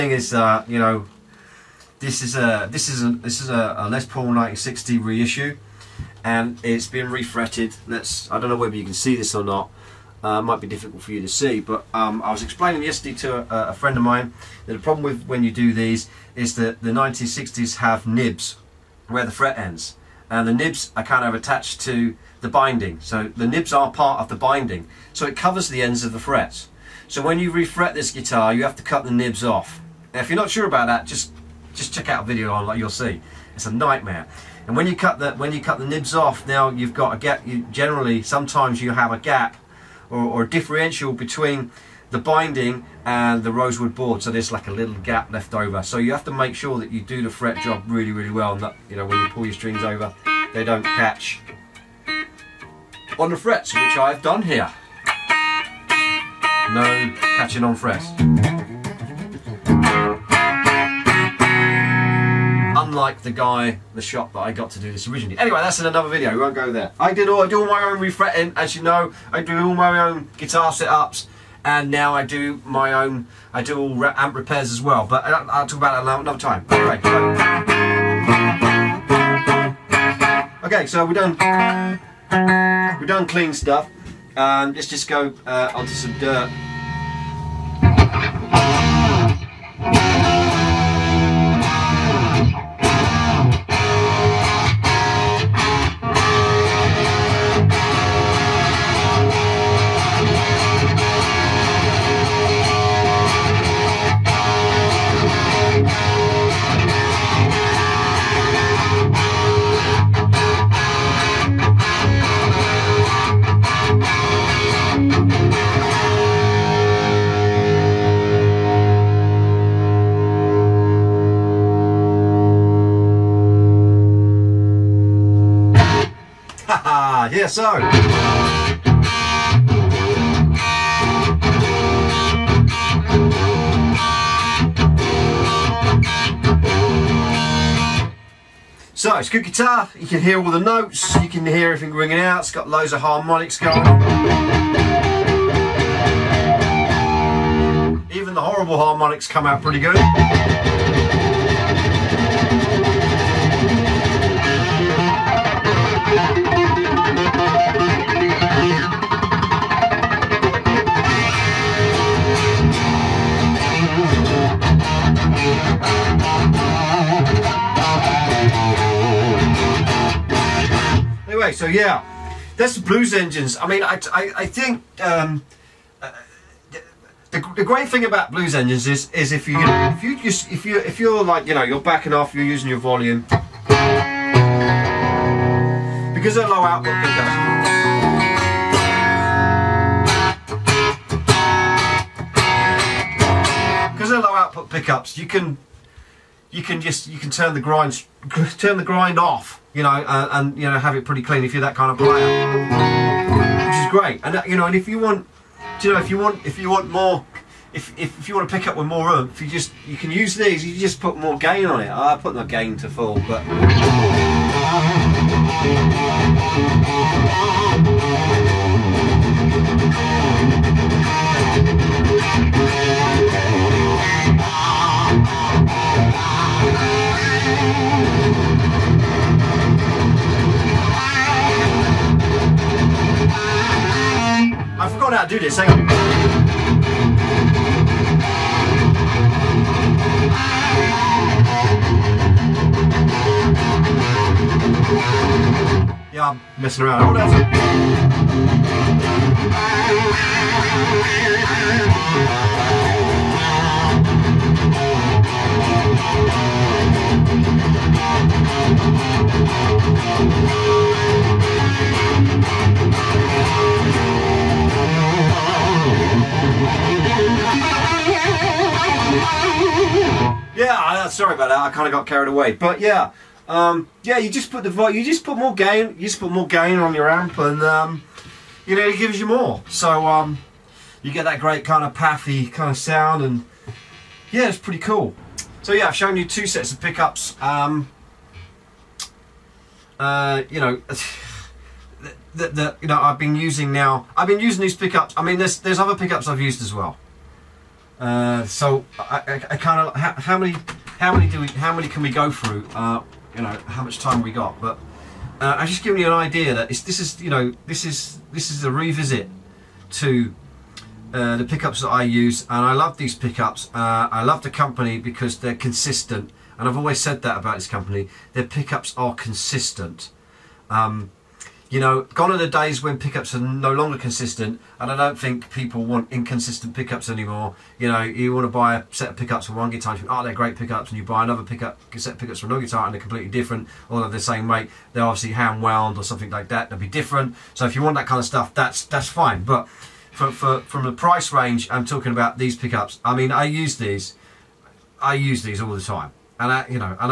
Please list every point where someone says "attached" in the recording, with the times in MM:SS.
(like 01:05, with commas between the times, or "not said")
00:21.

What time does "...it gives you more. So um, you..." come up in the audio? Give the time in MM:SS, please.
04:38.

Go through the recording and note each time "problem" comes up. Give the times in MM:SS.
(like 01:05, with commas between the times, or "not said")
00:14.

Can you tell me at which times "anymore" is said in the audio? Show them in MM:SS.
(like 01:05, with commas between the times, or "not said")
05:27.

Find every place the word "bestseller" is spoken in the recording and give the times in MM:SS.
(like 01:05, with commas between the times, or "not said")
not said.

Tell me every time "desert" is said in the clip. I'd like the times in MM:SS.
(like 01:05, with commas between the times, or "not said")
not said.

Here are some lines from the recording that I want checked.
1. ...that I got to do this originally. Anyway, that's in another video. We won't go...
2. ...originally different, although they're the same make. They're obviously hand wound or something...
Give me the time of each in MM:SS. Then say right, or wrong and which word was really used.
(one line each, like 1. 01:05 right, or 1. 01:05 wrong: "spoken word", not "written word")
1. 01:04 right
2. 05:33 wrong: "completely", not "originally".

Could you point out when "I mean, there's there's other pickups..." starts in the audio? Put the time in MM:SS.
04:55.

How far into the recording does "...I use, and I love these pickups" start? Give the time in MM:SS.
05:11.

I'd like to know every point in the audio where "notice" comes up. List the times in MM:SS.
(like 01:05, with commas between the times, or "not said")
not said.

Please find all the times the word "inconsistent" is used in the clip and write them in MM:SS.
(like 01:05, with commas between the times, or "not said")
05:26.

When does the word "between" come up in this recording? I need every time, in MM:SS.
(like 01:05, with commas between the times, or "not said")
00:41.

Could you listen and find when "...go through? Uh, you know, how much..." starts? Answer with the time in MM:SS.
05:02.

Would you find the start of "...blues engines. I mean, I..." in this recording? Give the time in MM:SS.
02:52.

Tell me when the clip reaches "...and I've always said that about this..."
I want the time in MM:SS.
05:16.